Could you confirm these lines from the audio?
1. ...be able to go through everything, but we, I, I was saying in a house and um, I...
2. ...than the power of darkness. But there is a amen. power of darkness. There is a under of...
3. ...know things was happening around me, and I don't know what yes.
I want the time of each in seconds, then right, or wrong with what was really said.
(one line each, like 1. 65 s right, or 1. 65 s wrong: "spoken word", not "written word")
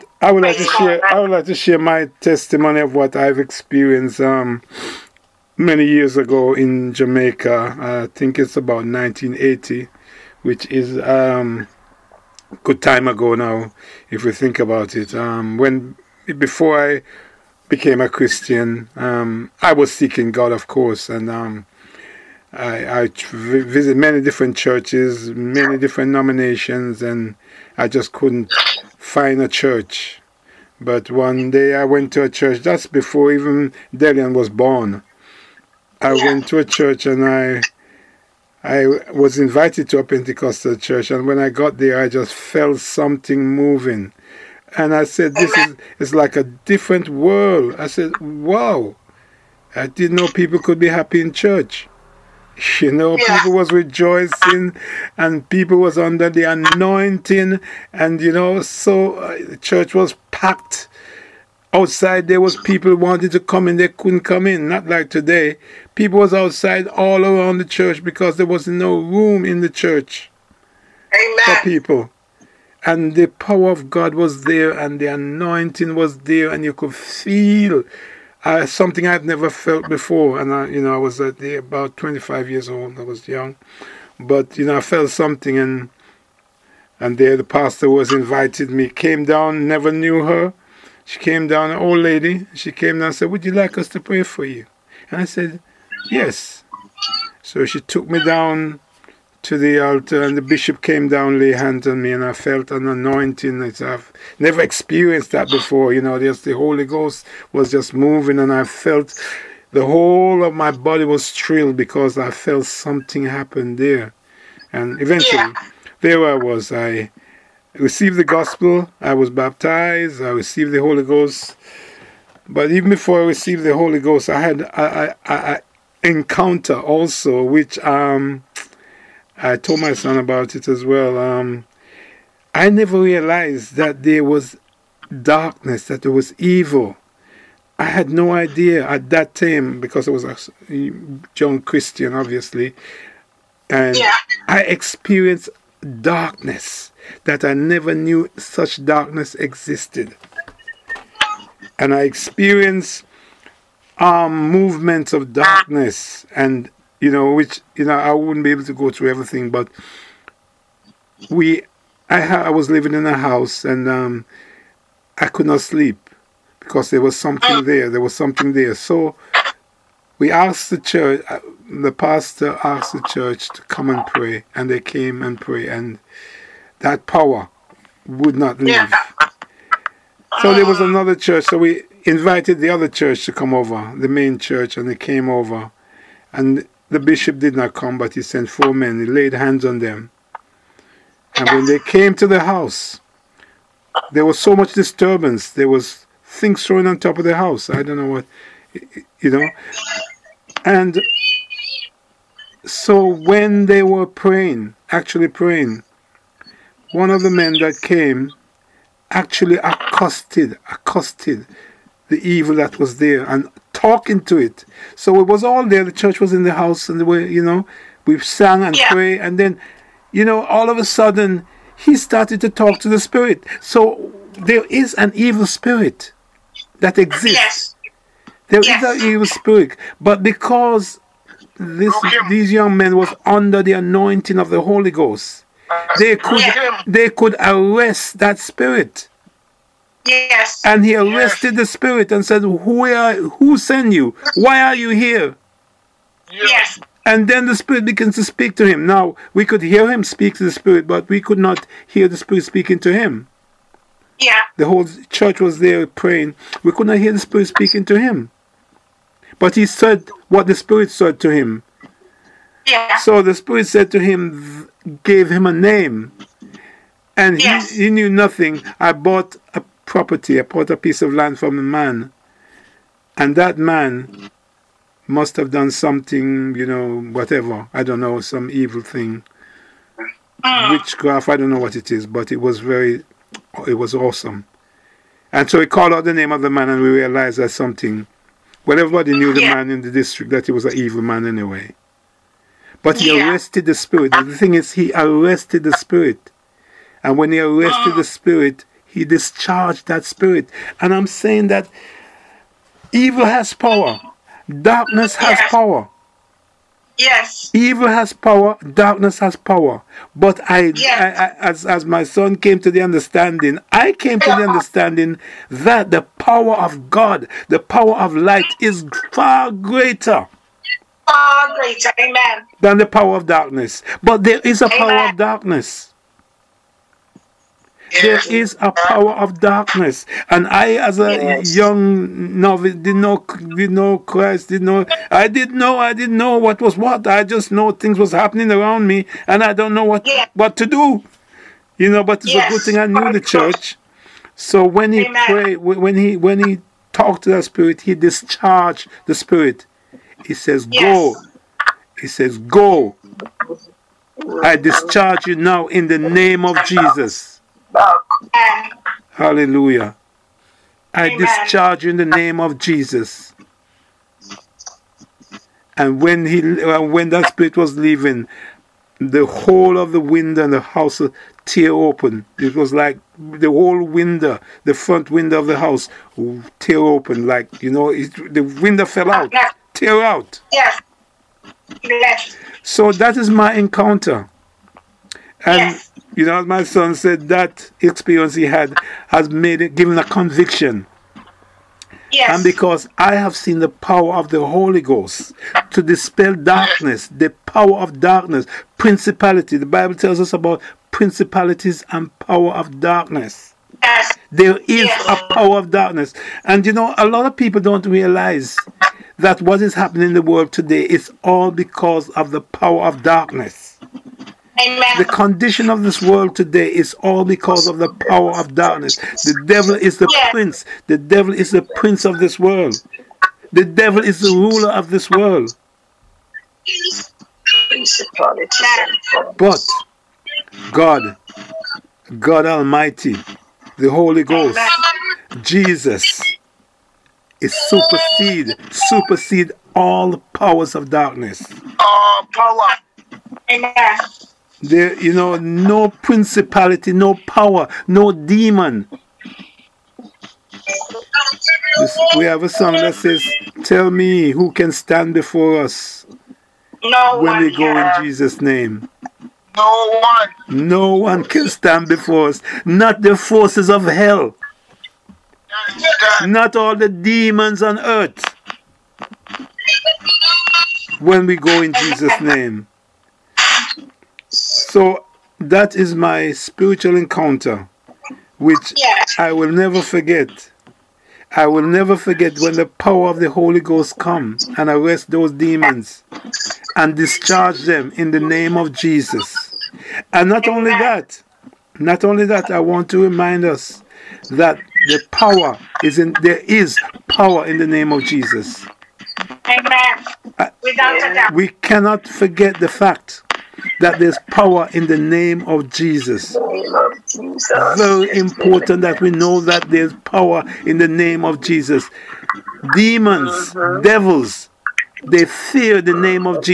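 1. 158 s wrong: "living", not "saying"
2. 322 s wrong: "power", not "under"
3. 337 s right.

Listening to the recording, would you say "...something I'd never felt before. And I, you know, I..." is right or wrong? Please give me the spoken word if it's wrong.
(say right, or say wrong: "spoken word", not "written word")
right.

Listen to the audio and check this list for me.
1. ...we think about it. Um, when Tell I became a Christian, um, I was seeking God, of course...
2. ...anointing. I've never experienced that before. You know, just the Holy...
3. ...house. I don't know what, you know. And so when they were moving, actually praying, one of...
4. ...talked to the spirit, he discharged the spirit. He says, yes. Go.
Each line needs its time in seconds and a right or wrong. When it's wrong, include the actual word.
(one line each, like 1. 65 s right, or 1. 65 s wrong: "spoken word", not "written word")
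1. 14 s wrong: "Before", not "Tell"
2. 102 s right
3. 197 s wrong: "praying", not "moving"
4. 346 s right.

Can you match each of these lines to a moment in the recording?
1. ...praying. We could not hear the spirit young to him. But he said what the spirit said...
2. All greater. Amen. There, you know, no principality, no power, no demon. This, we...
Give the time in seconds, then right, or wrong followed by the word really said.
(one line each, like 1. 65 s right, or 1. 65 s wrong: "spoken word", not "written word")
1. 255 s wrong: "speaking", not "young"
2. 441 s wrong: "power", not "greater".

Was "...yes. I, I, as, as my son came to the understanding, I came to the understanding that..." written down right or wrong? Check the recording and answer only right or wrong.
right.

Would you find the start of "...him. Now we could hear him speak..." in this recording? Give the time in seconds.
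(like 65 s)
248 s.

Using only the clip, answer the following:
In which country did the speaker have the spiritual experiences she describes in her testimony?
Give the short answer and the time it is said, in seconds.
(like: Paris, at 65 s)
Jamaica, at 6 s.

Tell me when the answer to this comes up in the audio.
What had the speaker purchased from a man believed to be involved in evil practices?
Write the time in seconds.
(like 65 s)
270 s.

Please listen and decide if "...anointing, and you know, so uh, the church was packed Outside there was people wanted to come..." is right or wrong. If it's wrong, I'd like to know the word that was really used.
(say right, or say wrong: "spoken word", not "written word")
right.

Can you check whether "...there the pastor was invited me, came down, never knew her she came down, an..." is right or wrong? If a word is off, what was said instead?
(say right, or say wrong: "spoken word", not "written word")
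right.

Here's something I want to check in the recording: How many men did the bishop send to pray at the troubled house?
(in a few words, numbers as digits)
4.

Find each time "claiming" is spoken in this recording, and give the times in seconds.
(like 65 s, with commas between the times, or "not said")
not said.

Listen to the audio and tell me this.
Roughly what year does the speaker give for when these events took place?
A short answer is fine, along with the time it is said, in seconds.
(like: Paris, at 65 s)
1980, at 8 s.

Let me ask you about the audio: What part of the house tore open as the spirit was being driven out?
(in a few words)
the front window.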